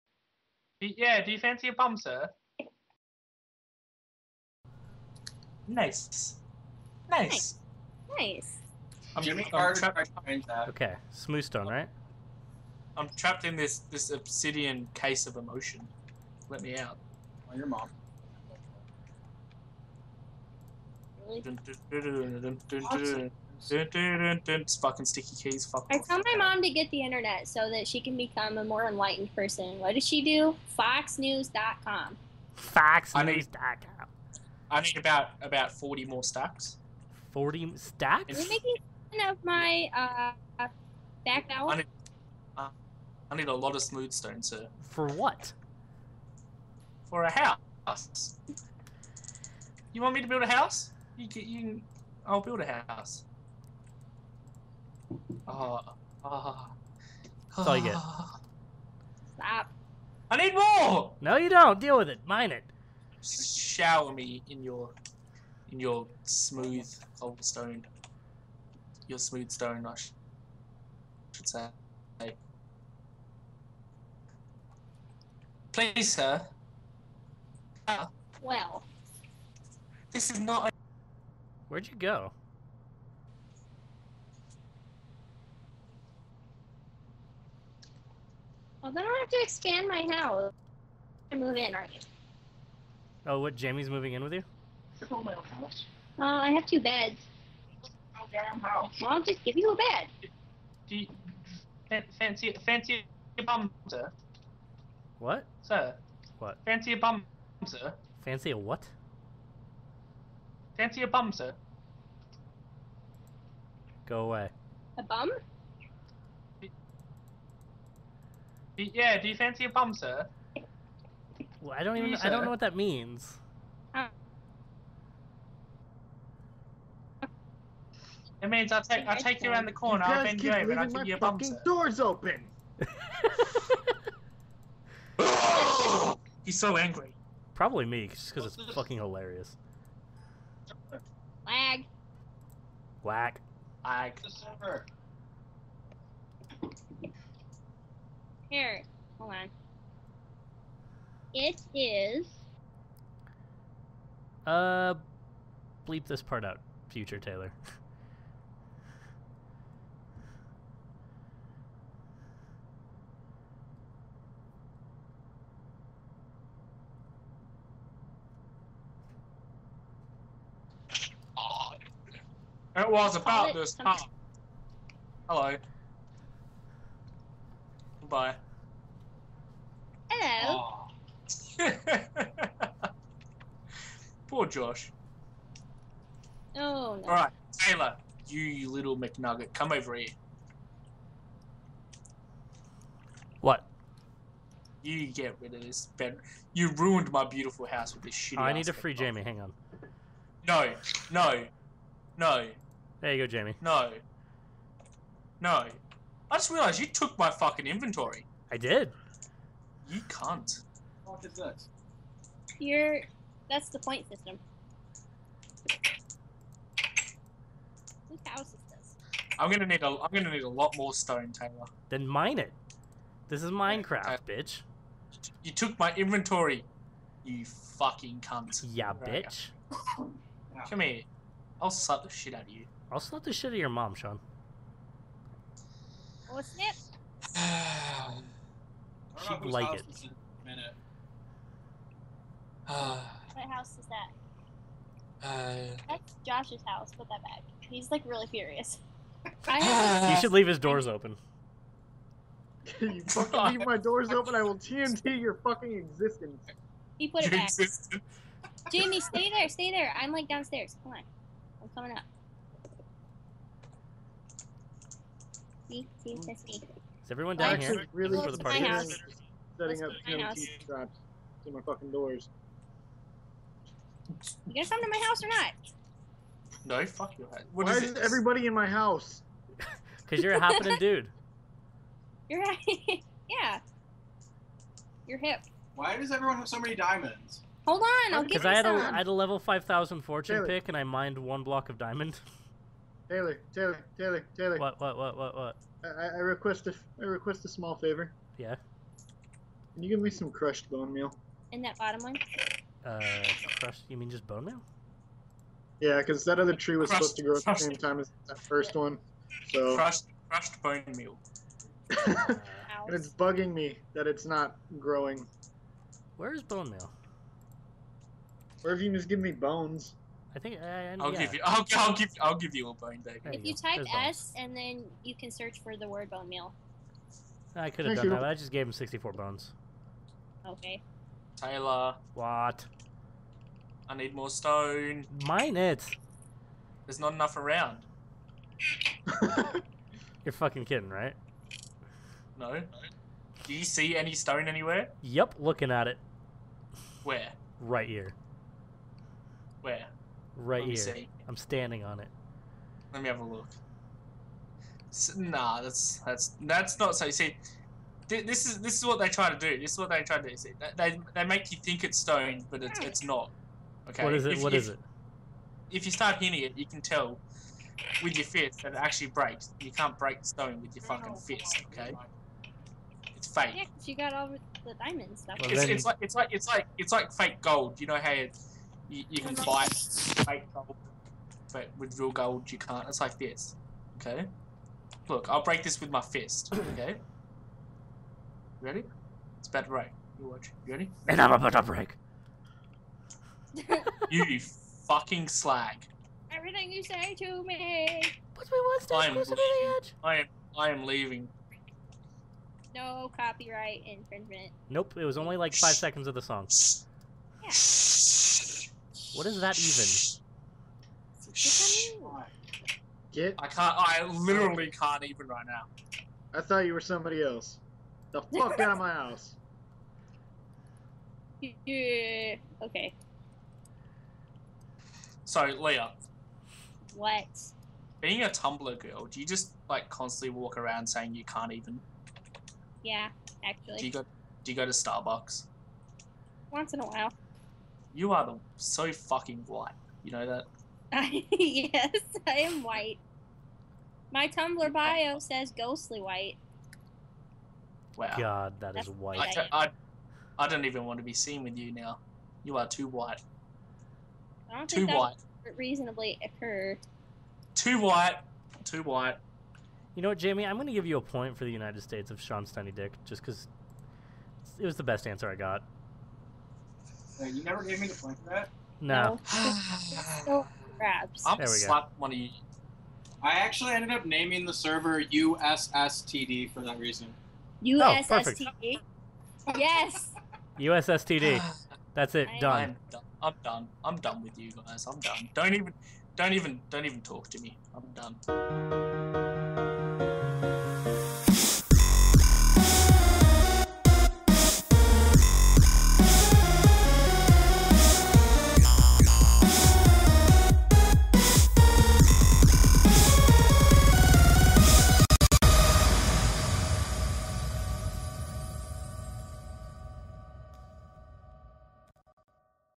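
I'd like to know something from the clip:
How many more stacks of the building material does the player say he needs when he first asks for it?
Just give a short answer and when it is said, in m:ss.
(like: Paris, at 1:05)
40, at 0:35.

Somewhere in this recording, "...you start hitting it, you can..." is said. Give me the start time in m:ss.
6:05.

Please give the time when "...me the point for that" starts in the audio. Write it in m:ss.
7:47.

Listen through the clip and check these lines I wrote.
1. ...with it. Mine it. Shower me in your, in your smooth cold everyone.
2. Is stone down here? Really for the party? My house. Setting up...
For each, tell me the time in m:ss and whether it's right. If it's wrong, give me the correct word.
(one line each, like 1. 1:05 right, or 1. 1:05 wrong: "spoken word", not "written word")
1. 1:01 wrong: "stone", not "everyone"
2. 4:25 wrong: "everyone", not "stone".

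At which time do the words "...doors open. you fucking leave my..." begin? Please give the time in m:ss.
4:10.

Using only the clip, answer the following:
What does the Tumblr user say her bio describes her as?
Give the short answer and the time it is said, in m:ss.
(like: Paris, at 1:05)
ghostly white, at 7:25.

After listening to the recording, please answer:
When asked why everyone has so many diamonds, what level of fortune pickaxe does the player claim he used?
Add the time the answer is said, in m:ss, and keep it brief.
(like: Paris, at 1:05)
5,000, at 4:49.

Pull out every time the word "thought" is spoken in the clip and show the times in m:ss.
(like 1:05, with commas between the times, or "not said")
6:56.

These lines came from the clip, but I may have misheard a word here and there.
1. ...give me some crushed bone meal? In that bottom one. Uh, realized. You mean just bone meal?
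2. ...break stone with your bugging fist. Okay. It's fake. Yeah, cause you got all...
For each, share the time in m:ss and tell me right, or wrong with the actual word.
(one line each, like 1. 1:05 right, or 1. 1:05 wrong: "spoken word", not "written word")
1. 4:59 wrong: "crushed", not "realized"
2. 6:09 wrong: "fucking", not "bugging".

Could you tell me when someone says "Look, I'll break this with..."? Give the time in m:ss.
6:25.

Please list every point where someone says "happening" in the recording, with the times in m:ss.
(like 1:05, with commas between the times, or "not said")
4:40.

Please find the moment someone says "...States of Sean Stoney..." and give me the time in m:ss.
7:41.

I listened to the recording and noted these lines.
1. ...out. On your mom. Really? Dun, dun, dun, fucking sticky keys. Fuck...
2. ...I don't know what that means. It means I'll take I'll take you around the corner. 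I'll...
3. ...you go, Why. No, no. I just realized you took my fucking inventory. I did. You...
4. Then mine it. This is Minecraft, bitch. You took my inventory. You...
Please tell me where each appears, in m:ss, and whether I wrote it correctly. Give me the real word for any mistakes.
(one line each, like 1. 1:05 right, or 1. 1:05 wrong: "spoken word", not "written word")
1. 0:16 right
2. 2:02 right
3. 3:23 wrong: "Jamie", not "Why"
4. 3:41 right.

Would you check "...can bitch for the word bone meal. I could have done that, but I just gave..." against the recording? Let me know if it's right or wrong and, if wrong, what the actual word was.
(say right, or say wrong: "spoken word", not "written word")
wrong: "search", not "bitch".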